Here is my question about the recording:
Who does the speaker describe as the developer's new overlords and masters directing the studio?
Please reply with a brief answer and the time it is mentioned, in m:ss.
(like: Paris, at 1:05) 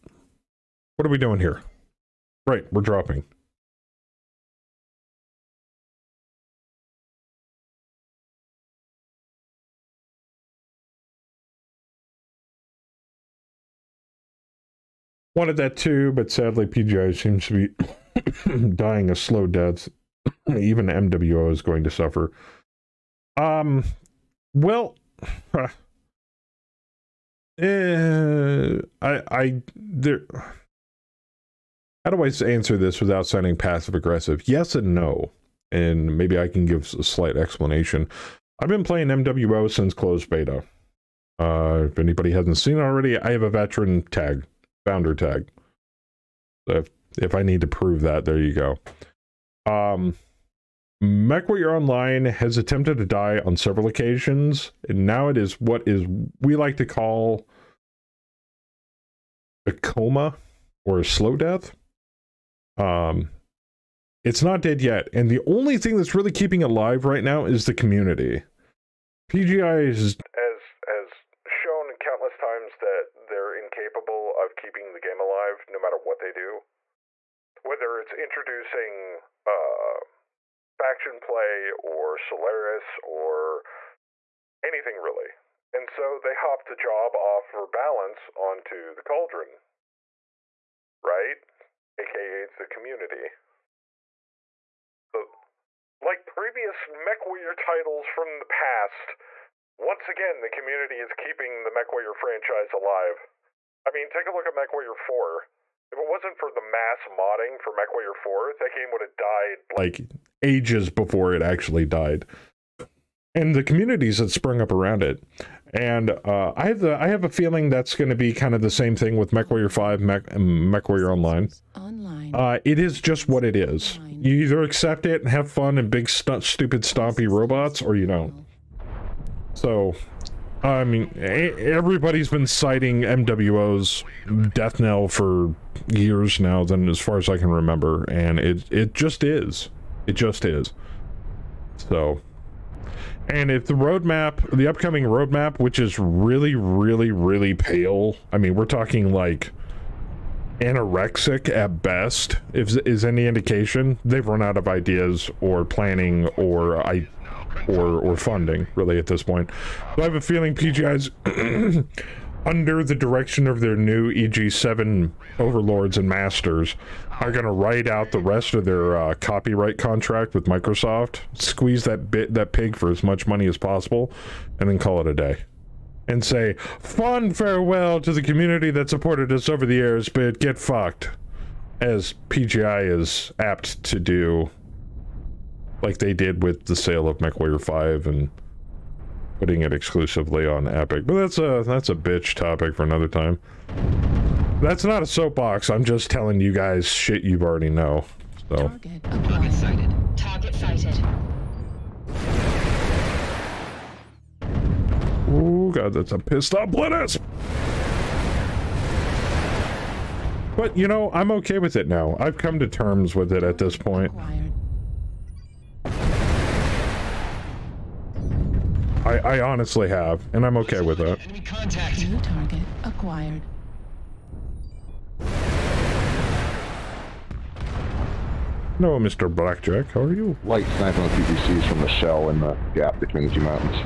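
EG7, at 2:44.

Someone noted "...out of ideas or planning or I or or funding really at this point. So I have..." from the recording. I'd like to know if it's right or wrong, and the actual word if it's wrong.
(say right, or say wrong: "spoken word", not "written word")
right.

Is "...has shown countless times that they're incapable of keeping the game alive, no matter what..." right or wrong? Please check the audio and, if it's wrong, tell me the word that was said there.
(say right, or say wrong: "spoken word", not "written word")
right.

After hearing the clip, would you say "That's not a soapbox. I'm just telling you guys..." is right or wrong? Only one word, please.
right.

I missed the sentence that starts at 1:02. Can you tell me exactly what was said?
Um, it's not dead yet, and the only thing that's really keeping it alive right now is the community.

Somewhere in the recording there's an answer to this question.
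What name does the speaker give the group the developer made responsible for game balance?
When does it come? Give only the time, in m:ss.
1:29.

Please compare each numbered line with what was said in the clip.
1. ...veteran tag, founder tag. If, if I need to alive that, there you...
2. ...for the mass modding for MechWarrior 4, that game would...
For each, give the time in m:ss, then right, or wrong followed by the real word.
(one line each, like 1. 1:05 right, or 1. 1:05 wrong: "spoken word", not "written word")
1. 0:43 wrong: "prove", not "alive"
2. 1:46 right.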